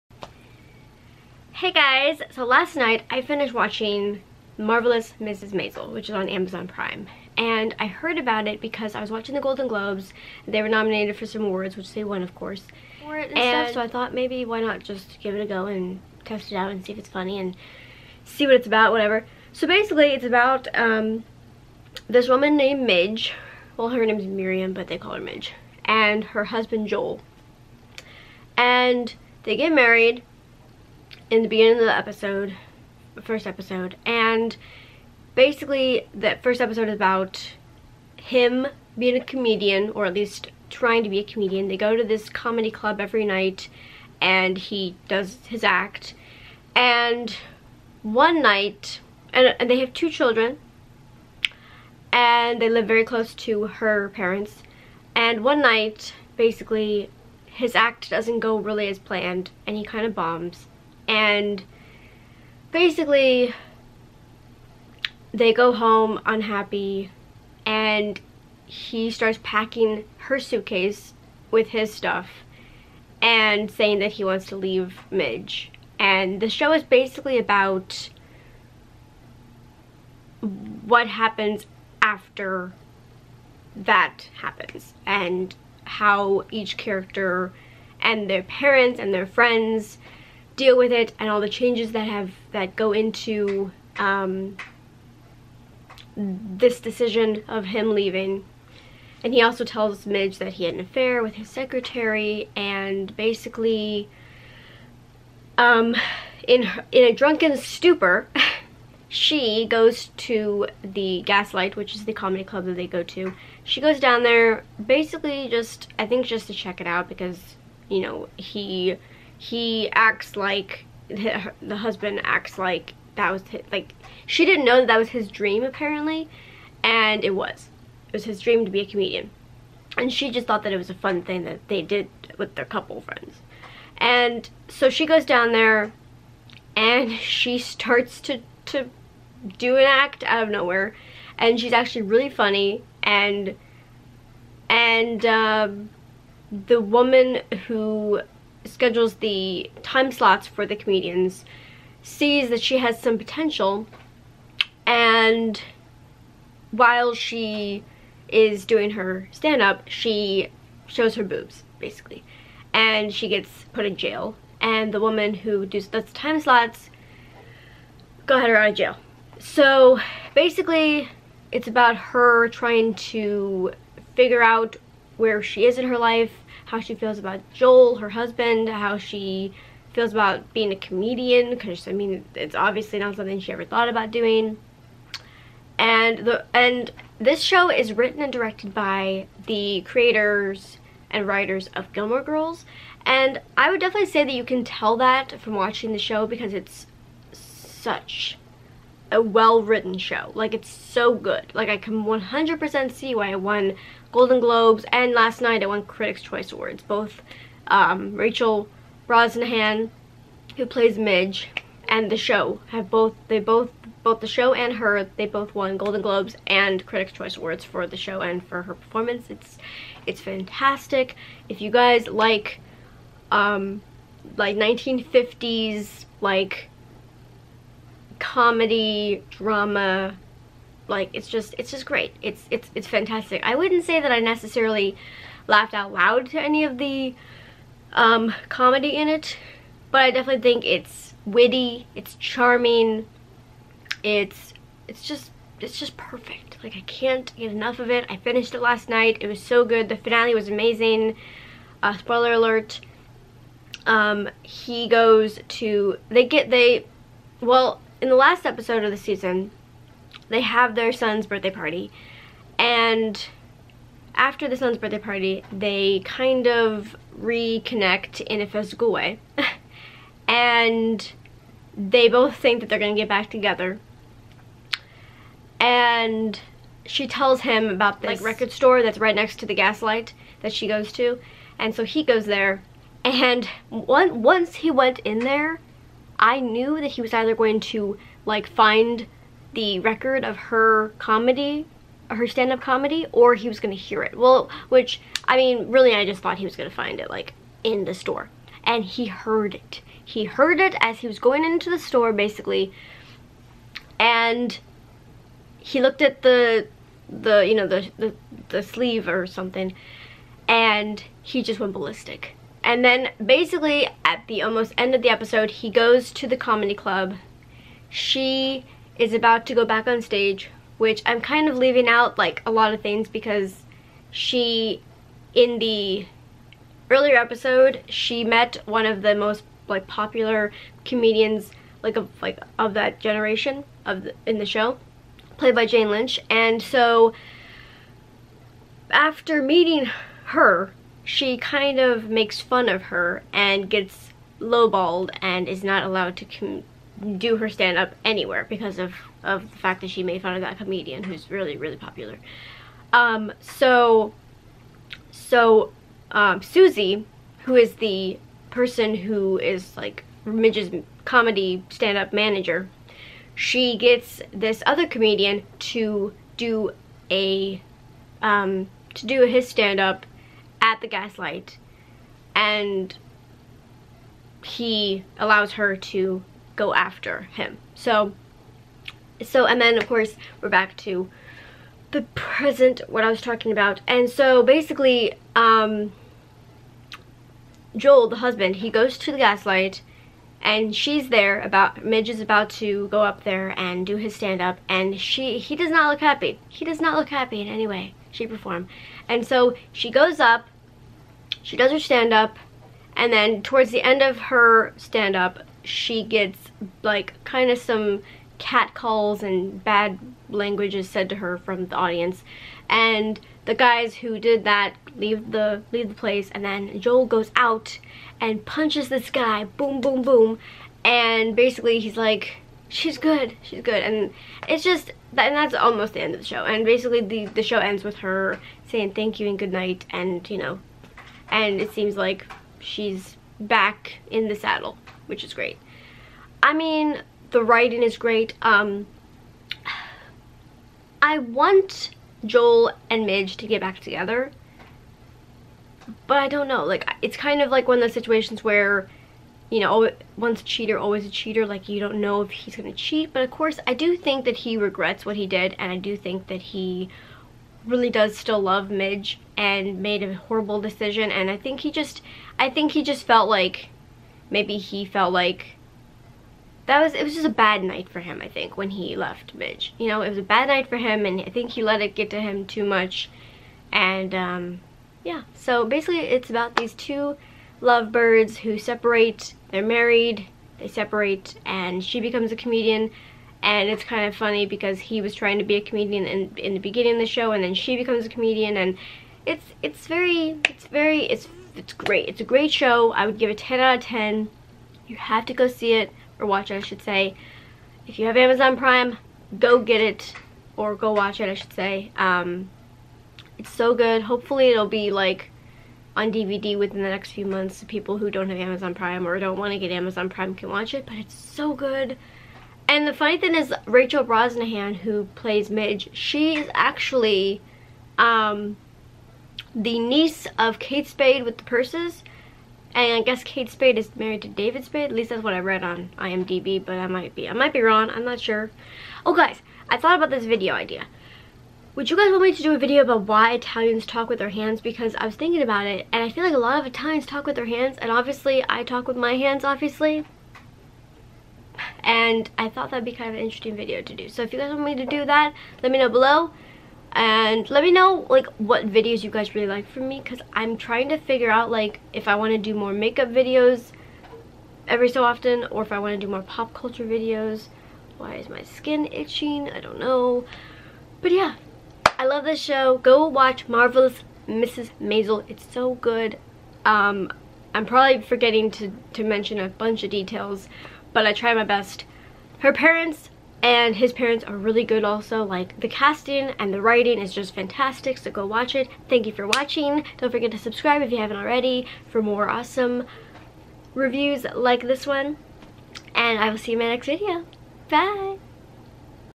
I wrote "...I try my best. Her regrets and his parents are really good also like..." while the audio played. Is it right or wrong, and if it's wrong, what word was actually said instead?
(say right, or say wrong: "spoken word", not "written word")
wrong: "parents", not "regrets".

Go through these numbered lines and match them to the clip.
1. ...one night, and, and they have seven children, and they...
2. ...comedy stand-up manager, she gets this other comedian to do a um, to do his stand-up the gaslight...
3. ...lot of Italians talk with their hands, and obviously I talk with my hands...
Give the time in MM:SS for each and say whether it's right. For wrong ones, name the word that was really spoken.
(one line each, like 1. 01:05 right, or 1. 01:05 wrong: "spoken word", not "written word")
1. 00:48 wrong: "two", not "seven"
2. 06:01 right
3. 08:56 right.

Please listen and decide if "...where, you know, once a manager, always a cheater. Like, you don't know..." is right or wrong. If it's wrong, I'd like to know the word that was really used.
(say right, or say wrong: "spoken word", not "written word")
wrong: "cheater", not "manager".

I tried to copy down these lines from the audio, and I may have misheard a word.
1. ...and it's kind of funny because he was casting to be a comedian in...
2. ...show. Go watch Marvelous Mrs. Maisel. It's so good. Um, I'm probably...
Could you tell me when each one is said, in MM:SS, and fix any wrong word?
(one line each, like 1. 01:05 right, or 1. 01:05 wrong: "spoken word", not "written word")
1. 08:03 wrong: "trying", not "casting"
2. 09:22 right.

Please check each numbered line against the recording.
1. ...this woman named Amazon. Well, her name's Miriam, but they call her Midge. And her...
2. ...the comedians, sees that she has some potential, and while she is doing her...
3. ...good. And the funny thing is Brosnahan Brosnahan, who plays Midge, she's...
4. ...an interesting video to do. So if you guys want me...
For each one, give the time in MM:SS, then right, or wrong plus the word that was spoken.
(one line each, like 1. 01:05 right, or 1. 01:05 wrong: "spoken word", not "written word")
1. 00:22 wrong: "Midge", not "Amazon"
2. 02:30 right
3. 08:31 wrong: "Rachel", not "Brosnahan"
4. 09:03 right.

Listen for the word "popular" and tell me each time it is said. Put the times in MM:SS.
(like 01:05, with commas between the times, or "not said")
05:29, 05:51.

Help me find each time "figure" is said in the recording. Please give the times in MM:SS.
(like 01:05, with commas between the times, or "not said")
02:54, 09:10.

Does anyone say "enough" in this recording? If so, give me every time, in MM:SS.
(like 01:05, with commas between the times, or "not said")
04:07.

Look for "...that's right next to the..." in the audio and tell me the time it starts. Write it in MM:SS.
04:38.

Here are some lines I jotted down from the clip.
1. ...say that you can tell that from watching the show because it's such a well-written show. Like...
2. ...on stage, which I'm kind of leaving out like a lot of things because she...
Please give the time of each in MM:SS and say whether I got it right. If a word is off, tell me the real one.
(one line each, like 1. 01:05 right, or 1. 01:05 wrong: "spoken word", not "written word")
1. 03:14 right
2. 05:19 right.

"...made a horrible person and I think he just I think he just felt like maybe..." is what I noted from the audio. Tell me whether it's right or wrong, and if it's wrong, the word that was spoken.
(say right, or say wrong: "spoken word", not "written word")
wrong: "decision", not "person".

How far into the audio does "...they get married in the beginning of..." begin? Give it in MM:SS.
00:29.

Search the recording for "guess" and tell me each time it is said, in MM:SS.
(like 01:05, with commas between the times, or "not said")
08:43.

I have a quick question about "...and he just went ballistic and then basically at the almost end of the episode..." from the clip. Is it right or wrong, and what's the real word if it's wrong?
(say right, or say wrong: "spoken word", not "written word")
right.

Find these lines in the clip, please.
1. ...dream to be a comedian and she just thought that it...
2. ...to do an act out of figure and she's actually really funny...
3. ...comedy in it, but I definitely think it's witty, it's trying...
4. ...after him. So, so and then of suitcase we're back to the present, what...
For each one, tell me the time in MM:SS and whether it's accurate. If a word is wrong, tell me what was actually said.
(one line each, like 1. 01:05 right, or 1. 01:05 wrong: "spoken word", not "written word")
1. 02:08 right
2. 02:18 wrong: "nowhere", not "figure"
3. 03:58 wrong: "charming", not "trying"
4. 06:16 wrong: "course", not "suitcase".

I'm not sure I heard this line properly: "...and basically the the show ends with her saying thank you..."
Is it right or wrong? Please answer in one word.
right.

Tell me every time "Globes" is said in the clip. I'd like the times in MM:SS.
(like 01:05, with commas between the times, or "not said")
00:09, 03:24, 03:36.